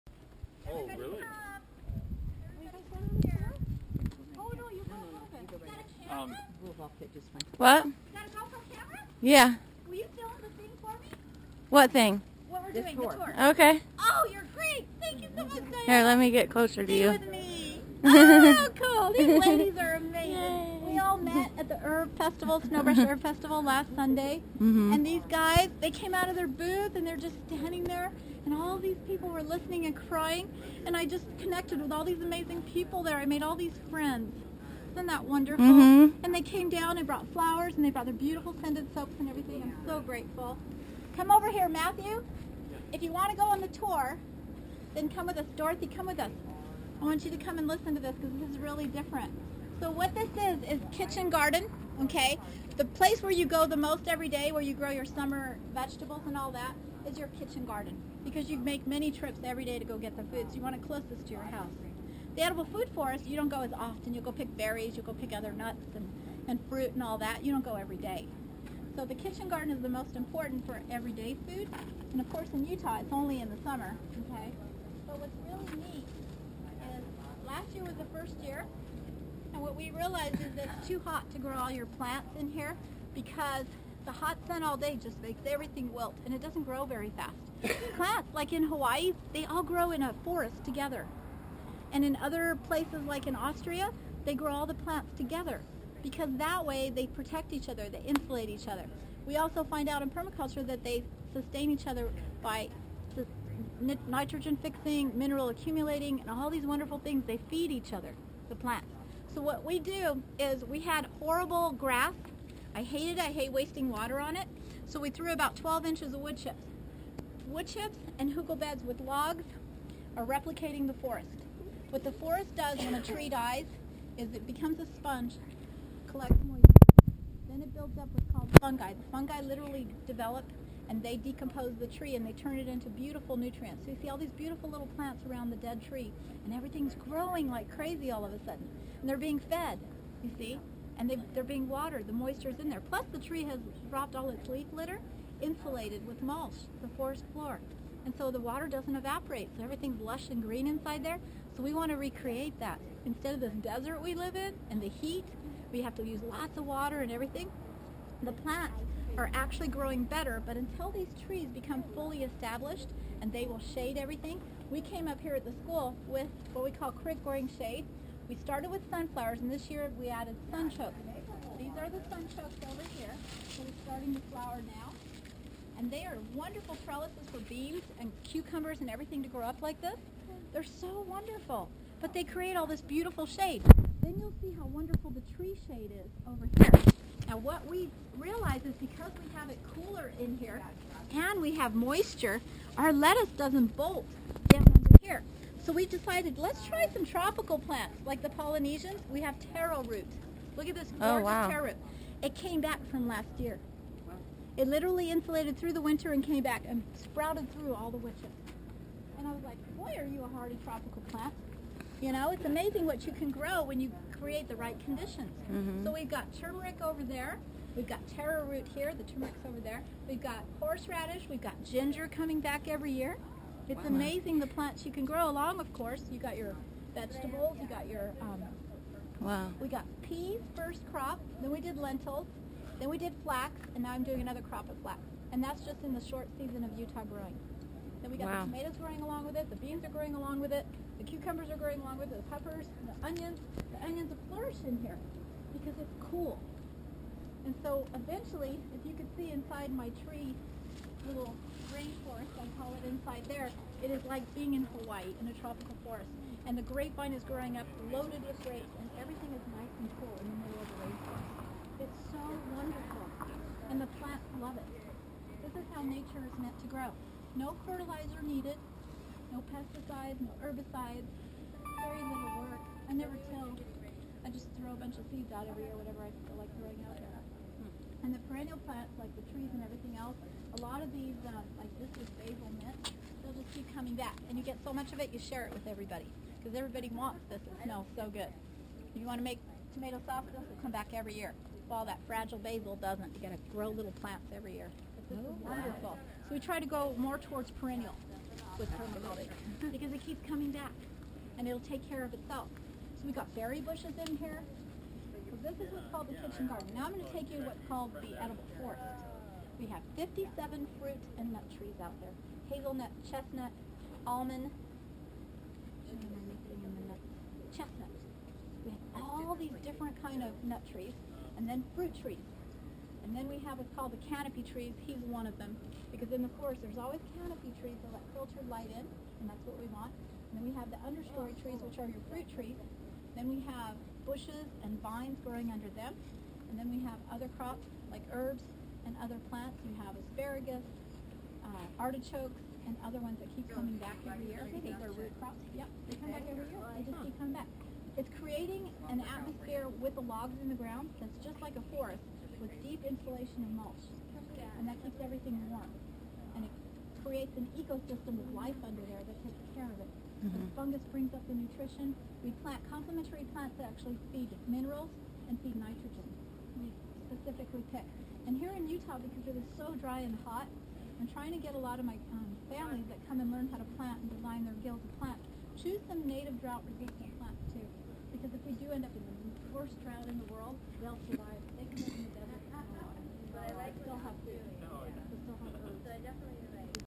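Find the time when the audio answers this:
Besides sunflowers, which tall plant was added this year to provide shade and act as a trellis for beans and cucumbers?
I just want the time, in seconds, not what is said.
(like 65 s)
170 s.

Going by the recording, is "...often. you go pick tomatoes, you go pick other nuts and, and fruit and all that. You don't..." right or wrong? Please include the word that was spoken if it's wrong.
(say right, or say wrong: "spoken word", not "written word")
wrong: "berries", not "tomatoes".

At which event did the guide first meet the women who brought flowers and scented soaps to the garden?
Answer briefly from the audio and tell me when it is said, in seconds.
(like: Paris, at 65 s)
Snowbrush Herb Festival, at 22 s.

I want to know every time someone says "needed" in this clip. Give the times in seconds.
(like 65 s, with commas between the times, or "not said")
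268 s.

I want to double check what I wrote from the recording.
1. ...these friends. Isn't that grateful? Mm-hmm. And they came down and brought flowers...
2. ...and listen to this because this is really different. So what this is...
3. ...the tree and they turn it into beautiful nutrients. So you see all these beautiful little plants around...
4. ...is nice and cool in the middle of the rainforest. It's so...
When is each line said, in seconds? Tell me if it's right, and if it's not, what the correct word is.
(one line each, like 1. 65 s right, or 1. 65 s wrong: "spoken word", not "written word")
1. 33 s wrong: "wonderful", not "grateful"
2. 47 s right
3. 131 s right
4. 259 s right.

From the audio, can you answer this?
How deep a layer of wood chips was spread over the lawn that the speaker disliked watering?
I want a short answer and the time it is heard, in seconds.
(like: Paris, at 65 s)
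12 inches, at 115 s.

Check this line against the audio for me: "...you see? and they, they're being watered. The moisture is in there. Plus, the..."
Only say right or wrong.
right.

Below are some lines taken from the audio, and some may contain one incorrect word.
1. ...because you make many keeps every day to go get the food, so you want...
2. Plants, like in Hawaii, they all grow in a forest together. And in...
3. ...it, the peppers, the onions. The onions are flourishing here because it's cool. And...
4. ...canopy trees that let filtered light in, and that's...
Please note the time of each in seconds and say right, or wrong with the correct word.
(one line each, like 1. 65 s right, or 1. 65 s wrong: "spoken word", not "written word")
1. 58 s wrong: "trips", not "keeps"
2. 87 s right
3. 242 s right
4. 327 s right.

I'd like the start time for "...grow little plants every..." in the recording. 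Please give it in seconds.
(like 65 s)
293 s.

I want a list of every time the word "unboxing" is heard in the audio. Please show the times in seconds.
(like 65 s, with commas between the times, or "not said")
not said.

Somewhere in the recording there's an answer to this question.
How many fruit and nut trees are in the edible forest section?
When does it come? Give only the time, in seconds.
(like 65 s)
309 s.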